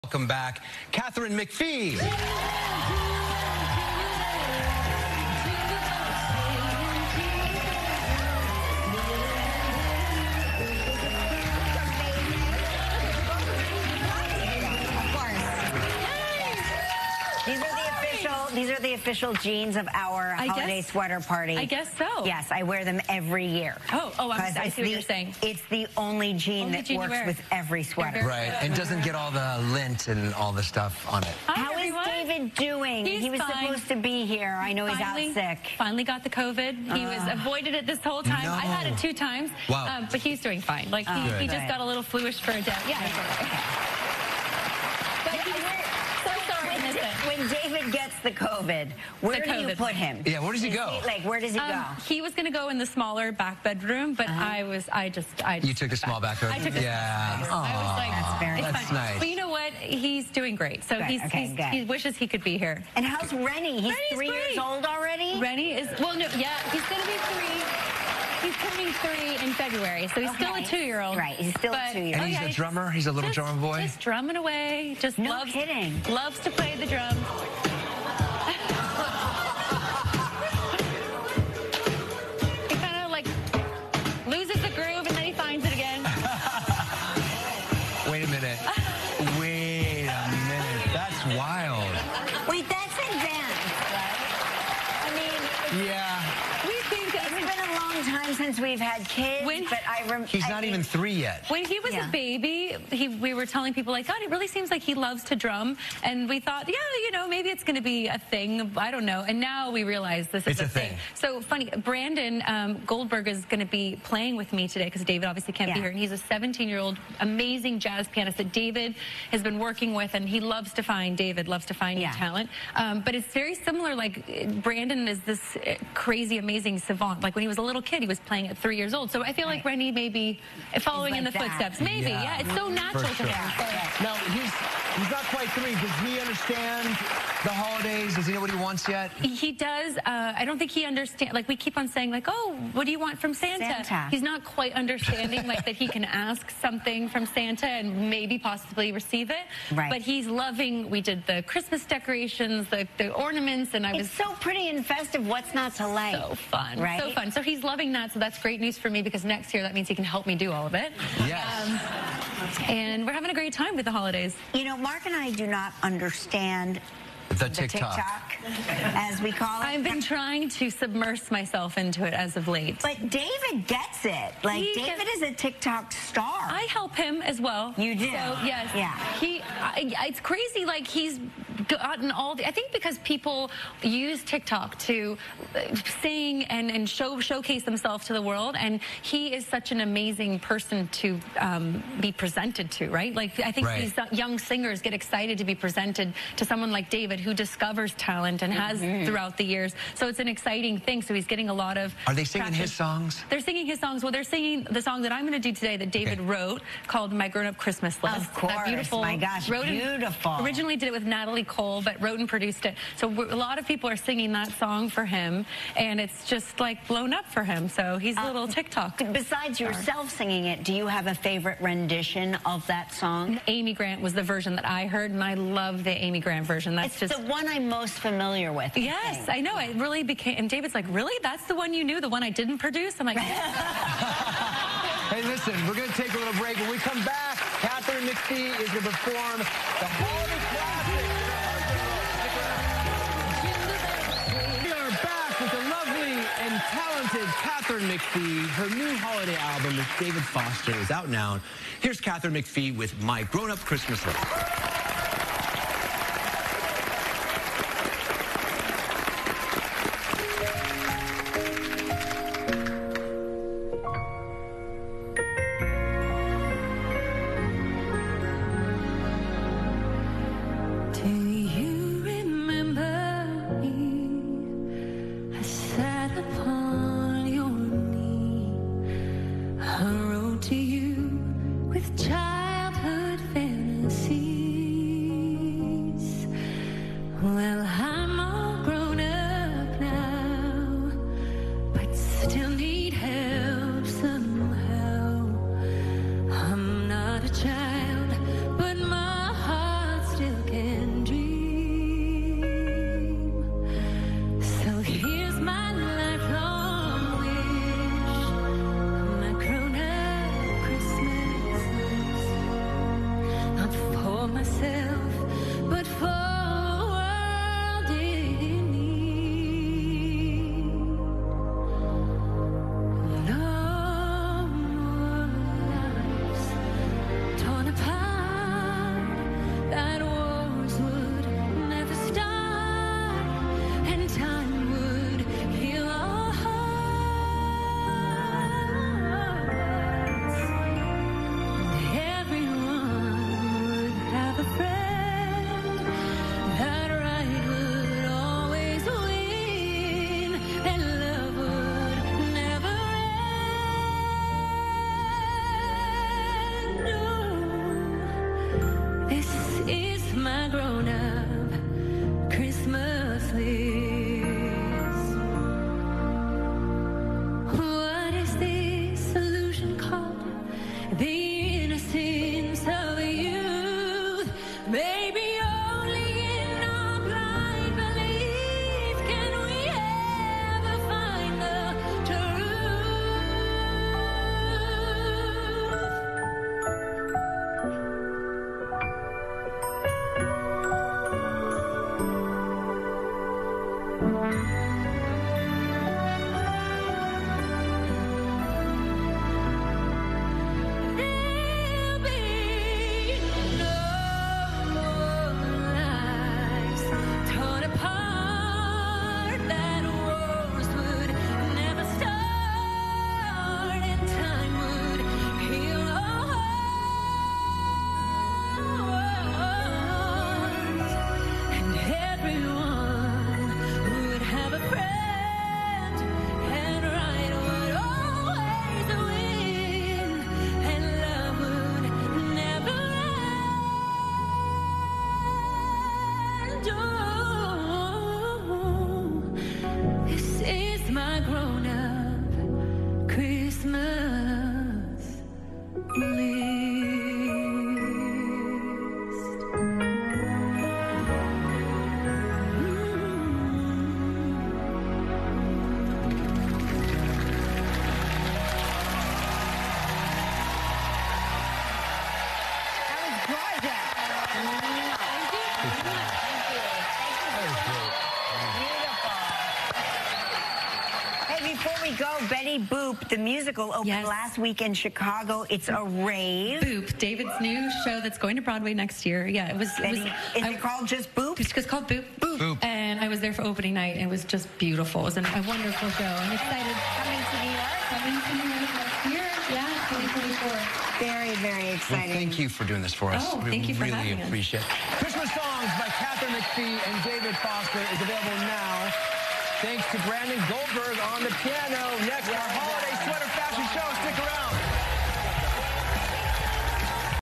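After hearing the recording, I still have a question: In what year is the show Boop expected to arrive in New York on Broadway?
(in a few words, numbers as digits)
2024.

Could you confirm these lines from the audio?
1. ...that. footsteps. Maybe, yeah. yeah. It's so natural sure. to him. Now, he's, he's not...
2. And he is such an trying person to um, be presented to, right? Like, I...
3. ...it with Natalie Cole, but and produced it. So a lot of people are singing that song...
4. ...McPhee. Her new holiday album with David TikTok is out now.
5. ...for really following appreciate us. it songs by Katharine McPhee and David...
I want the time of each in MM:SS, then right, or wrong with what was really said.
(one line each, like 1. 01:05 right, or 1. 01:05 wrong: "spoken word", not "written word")
1. 02:11 right
2. 03:08 wrong: "amazing", not "trying"
3. 03:30 right
4. 04:07 wrong: "Foster", not "TikTok"
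5. 08:13 wrong: "having", not "following".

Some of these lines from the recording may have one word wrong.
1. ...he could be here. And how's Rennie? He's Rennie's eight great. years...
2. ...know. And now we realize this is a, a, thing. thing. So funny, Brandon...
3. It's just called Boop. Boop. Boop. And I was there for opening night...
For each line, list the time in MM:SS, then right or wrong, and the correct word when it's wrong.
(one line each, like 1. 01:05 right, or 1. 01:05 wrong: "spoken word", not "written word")
1. 01:02 wrong: "three", not "eight"
2. 01:49 right
3. 08:01 right.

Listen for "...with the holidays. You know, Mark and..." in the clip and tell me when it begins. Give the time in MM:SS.
02:43.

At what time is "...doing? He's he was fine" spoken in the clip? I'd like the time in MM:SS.
00:32.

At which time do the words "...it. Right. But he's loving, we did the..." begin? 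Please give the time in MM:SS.
02:29.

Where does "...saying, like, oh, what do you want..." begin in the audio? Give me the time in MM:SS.
02:21.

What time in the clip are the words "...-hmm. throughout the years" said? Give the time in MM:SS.
03:18.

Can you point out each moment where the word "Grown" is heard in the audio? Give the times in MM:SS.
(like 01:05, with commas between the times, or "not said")
03:27, 04:13.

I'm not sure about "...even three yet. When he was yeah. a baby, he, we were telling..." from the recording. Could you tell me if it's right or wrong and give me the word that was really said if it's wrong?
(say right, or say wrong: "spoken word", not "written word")
right.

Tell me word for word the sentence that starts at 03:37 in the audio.
So he's a uh, little uh, TikTok.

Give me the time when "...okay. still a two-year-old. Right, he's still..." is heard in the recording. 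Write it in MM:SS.
01:10.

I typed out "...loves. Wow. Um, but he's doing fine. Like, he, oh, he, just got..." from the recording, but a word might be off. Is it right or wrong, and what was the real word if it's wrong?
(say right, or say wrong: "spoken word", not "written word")
wrong: "times", not "loves".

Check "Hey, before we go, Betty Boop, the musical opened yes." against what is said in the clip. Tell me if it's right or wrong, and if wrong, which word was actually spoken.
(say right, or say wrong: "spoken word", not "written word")
right.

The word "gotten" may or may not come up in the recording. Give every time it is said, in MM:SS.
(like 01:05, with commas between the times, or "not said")
03:01.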